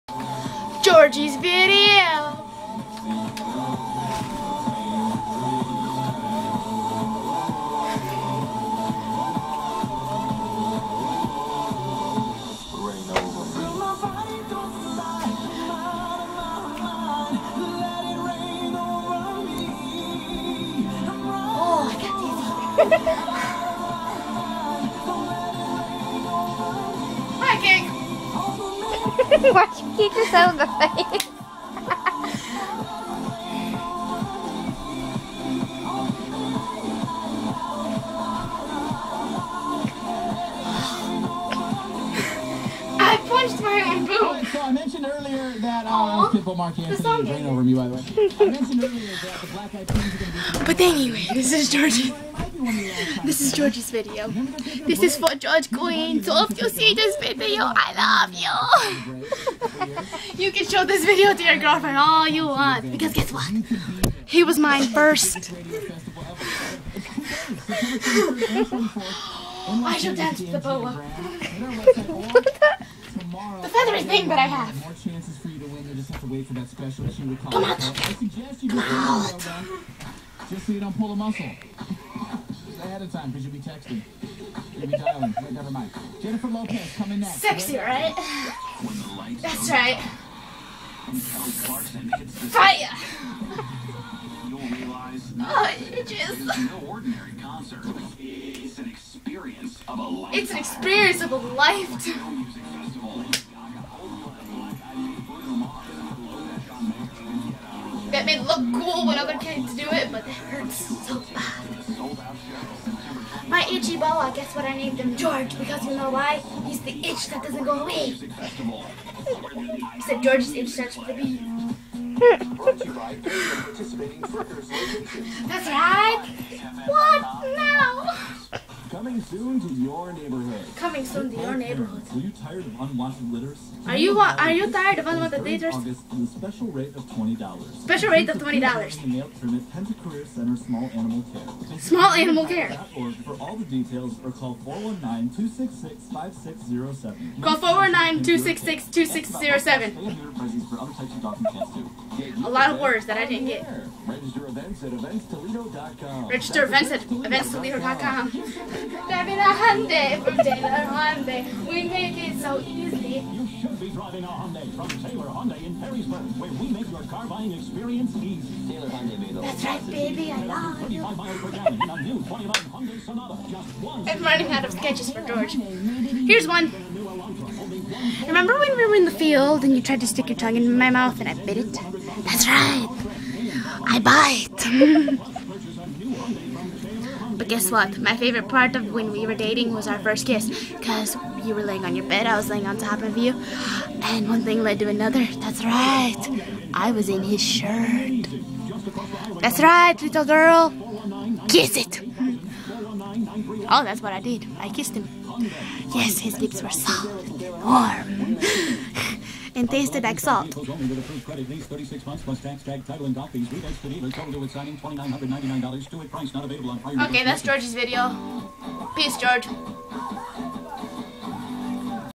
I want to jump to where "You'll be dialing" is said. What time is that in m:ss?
1:24.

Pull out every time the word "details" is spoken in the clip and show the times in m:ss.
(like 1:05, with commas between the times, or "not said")
2:23.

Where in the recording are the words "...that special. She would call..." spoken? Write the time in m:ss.
1:16.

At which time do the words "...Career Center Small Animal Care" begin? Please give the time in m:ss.
2:20.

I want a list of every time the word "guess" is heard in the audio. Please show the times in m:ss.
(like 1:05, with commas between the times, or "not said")
1:03, 1:54, 3:07.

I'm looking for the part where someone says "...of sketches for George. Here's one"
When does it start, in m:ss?
2:54.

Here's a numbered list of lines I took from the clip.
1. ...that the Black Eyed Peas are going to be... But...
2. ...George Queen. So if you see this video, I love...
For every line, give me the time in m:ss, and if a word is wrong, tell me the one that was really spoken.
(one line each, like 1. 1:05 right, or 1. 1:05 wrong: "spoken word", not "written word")
1. 0:49 right
2. 0:55 right.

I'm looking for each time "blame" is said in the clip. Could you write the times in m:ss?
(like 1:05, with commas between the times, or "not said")
not said.